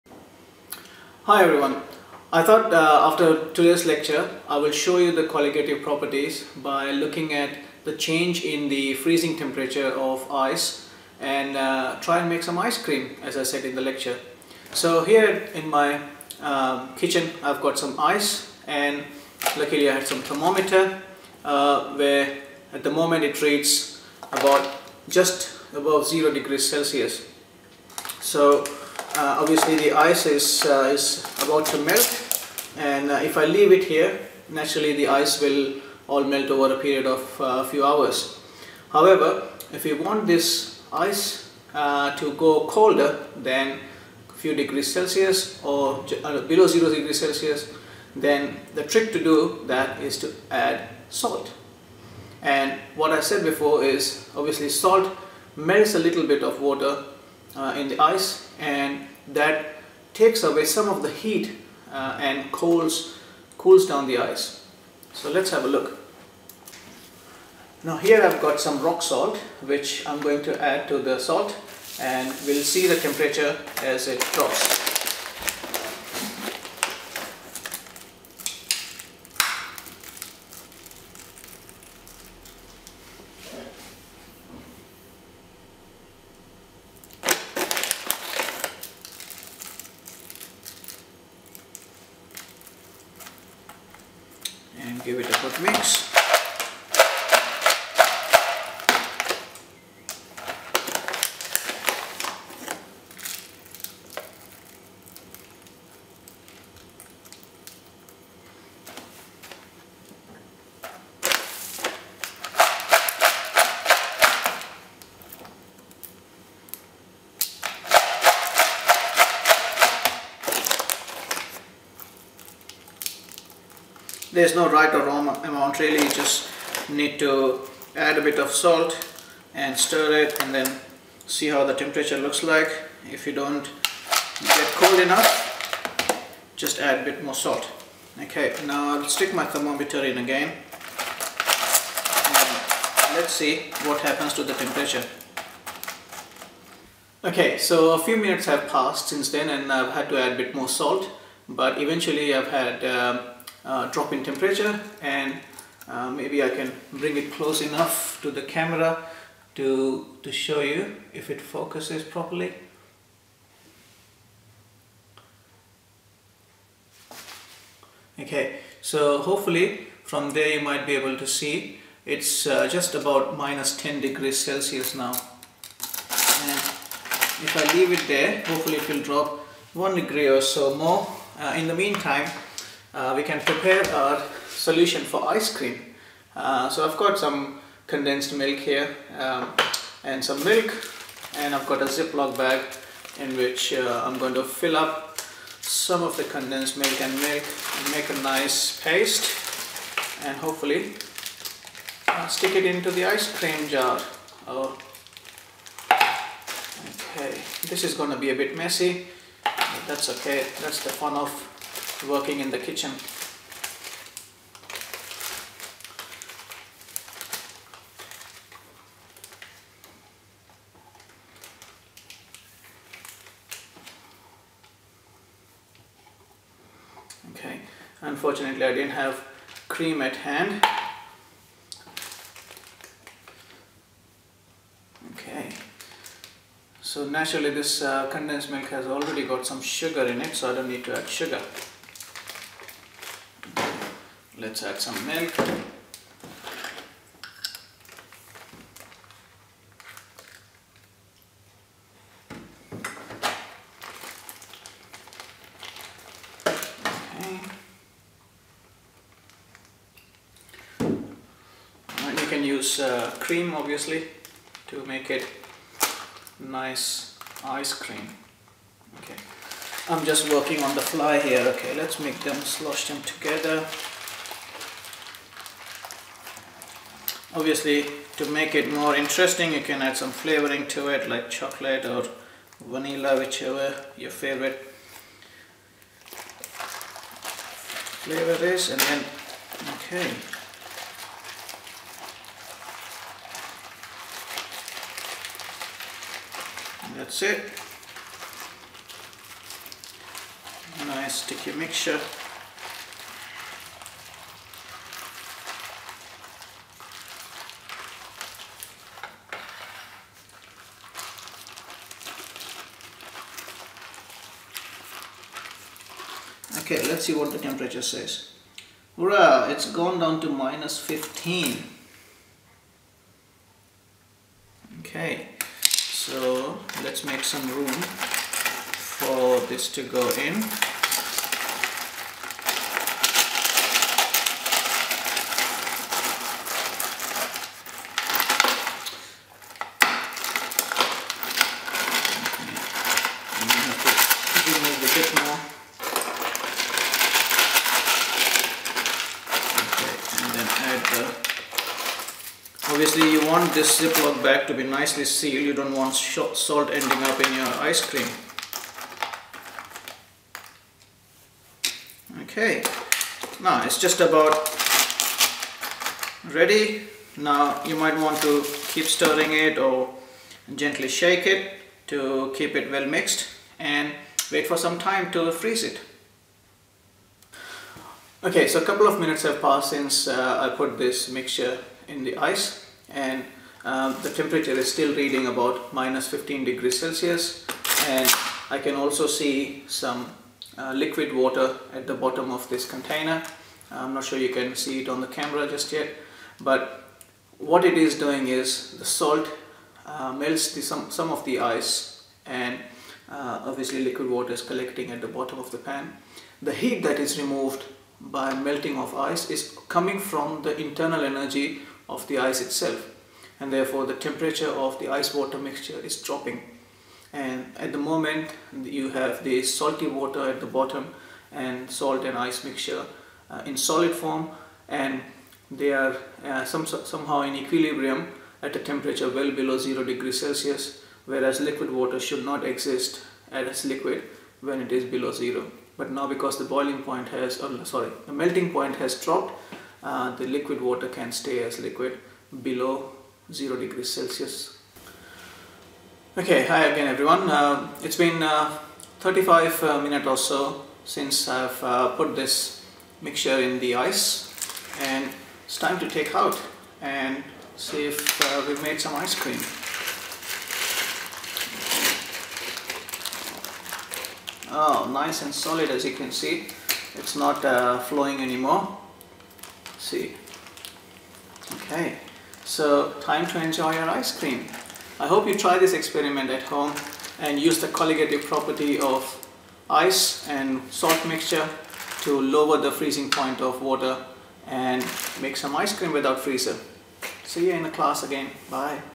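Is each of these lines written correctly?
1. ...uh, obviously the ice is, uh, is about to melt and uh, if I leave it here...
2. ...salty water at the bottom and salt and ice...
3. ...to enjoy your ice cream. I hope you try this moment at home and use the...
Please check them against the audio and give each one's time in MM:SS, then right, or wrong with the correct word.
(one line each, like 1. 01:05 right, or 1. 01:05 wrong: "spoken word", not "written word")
1. 00:29 right
2. 06:59 right
3. 07:53 wrong: "experiment", not "moment".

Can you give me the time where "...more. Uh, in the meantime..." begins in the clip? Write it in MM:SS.
03:00.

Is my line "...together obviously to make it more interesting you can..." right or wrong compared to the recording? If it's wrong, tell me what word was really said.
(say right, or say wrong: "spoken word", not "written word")
right.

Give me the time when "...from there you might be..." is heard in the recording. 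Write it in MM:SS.
02:50.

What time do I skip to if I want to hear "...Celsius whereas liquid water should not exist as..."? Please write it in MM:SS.
07:10.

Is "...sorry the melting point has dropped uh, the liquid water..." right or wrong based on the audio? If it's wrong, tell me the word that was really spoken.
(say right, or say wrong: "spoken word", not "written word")
right.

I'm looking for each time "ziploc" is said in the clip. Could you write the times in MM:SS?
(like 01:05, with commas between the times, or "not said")
03:11, 05:53.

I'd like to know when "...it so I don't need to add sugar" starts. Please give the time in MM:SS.
04:00.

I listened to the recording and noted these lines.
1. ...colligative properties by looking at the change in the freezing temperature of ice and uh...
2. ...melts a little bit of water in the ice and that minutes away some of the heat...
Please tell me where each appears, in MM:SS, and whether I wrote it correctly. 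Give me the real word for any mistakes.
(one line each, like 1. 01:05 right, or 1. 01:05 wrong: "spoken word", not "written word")
1. 00:05 right
2. 00:55 wrong: "takes", not "minutes".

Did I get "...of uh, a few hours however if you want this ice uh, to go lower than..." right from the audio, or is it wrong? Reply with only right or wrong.
wrong.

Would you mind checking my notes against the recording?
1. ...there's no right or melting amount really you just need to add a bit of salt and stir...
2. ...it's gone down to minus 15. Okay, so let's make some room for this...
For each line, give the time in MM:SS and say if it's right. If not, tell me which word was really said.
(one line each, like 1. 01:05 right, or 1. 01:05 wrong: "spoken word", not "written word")
1. 02:04 wrong: "wrong", not "melting"
2. 05:19 right.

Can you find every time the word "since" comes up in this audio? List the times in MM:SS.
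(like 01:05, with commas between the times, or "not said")
02:29, 06:19, 07:30.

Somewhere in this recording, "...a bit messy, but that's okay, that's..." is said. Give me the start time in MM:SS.
03:28.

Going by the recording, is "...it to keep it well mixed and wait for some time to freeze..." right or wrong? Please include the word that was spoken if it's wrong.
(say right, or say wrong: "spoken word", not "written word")
right.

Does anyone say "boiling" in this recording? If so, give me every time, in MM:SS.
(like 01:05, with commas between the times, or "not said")
07:16.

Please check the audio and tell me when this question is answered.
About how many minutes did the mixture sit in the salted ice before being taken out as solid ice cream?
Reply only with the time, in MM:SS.
07:28.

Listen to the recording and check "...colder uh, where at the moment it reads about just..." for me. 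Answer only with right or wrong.
wrong.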